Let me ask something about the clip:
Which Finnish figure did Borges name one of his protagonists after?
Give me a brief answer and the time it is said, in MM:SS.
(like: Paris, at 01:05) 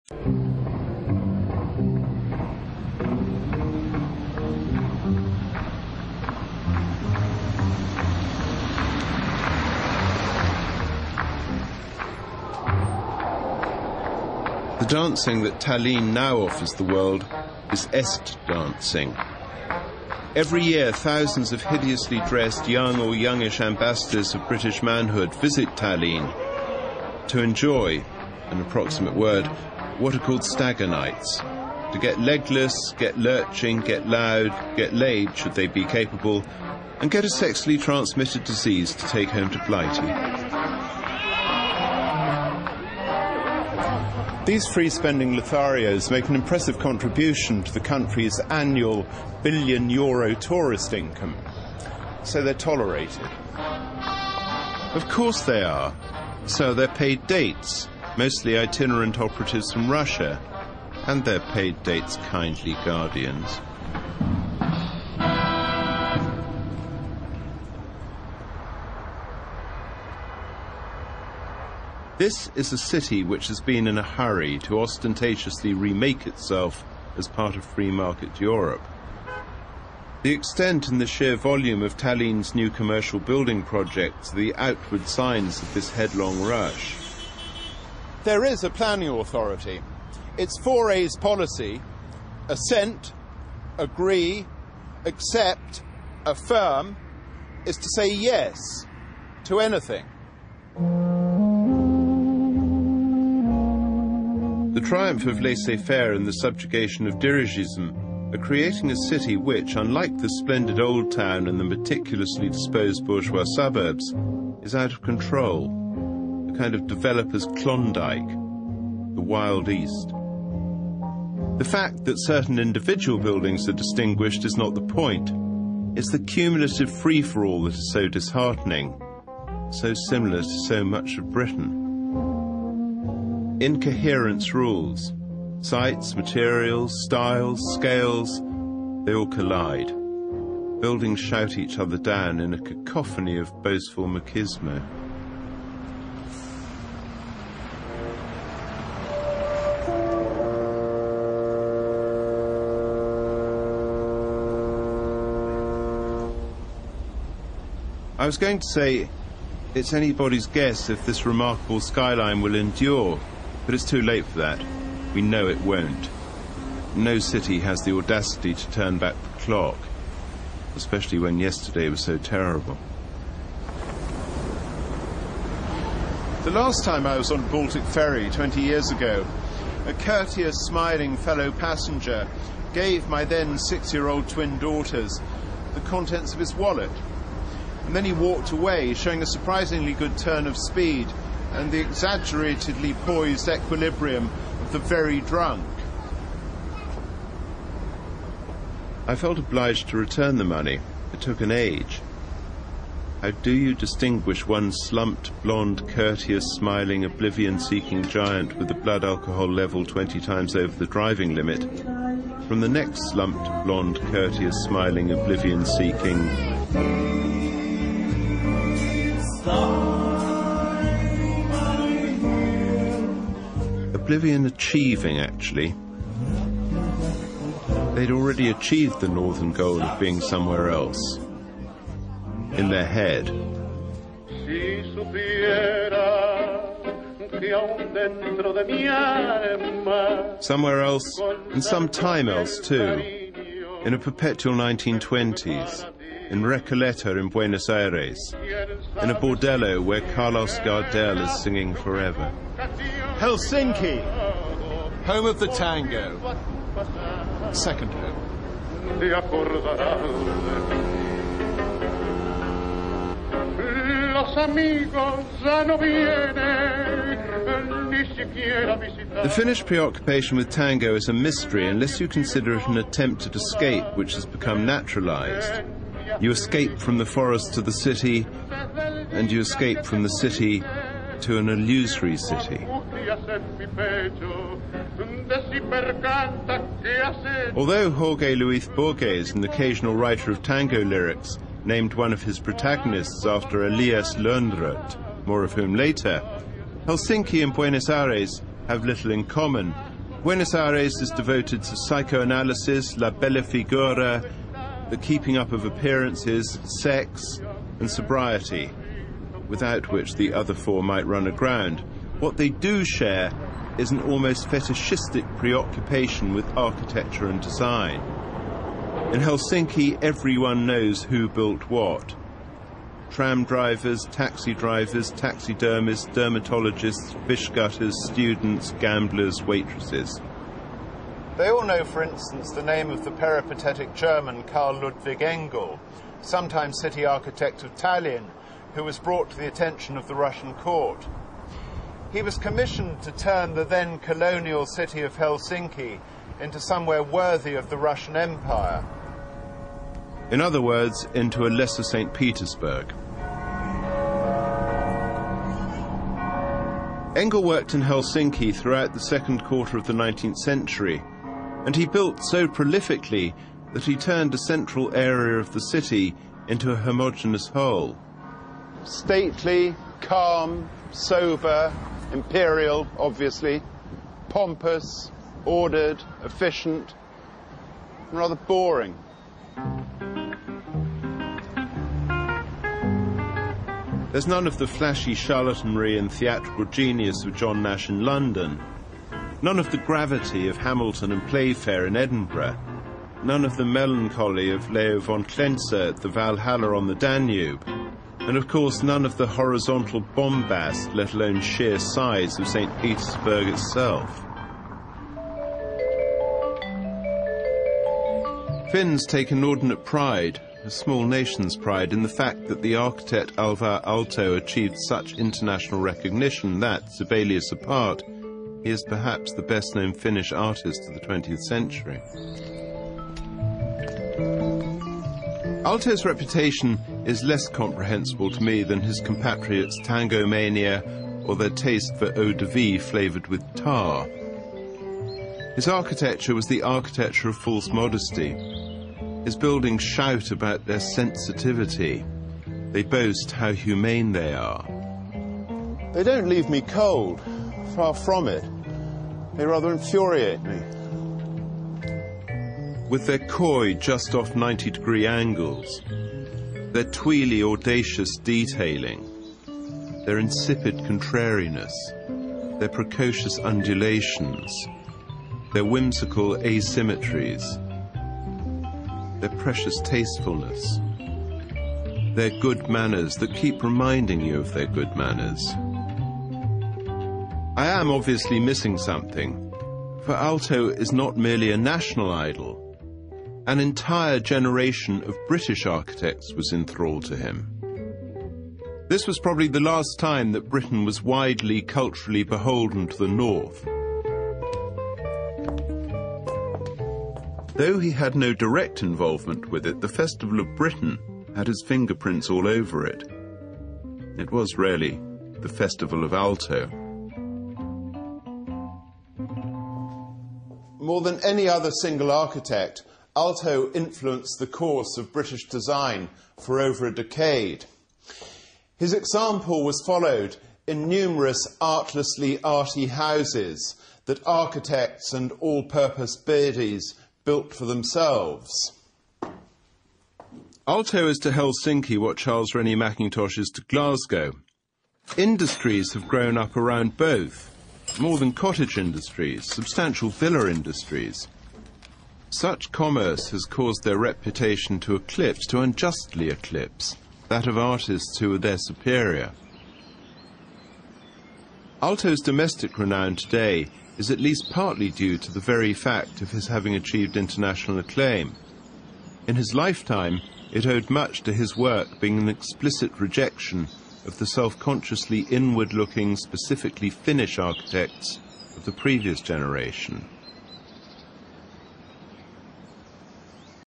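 Elias Lönnrot, at 04:53.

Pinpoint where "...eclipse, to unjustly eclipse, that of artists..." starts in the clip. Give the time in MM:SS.
09:04.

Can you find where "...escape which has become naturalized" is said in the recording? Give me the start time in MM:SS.
04:33.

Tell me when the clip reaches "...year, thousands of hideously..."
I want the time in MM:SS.
00:20.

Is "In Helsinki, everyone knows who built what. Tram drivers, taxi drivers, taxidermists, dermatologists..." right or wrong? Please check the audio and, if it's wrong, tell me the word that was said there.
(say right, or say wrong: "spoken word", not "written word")
right.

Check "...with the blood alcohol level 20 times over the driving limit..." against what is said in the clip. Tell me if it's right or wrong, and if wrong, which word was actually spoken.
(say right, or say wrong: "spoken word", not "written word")
right.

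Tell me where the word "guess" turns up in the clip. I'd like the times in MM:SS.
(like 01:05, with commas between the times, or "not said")
02:40.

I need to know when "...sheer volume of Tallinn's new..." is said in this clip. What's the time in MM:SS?
01:21.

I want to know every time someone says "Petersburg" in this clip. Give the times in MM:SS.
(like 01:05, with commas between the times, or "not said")
05:52, 06:42.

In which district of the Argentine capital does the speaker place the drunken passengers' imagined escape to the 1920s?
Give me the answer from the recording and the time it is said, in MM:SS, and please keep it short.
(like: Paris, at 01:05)
Recoleta, at 04:06.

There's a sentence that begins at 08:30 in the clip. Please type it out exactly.
More than any other single architect, Aalto influenced the course of British design for over a decade.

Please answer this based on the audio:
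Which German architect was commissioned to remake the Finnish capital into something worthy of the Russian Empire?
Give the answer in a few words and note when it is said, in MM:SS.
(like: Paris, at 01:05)
Karl Ludwig Engel, at 05:34.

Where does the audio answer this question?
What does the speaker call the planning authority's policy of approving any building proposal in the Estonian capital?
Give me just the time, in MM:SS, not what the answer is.
01:30.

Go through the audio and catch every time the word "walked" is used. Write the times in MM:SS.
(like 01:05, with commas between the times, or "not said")
03:08.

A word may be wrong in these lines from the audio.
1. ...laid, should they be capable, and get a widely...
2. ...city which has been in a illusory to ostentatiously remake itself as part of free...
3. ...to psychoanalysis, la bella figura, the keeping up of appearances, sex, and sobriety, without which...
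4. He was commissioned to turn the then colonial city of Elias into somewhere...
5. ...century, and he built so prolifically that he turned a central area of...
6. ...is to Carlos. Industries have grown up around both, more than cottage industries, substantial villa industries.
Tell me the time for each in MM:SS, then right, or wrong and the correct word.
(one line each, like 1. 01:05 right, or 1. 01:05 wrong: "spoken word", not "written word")
1. 00:34 wrong: "sexually", not "widely"
2. 01:12 wrong: "hurry", not "illusory"
3. 05:01 right
4. 05:42 wrong: "Helsinki", not "Elias"
5. 06:00 right
6. 08:53 wrong: "Glasgow", not "Carlos".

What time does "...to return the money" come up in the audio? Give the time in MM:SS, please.
03:19.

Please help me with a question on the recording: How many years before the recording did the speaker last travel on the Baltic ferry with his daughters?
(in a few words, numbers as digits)
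20 years.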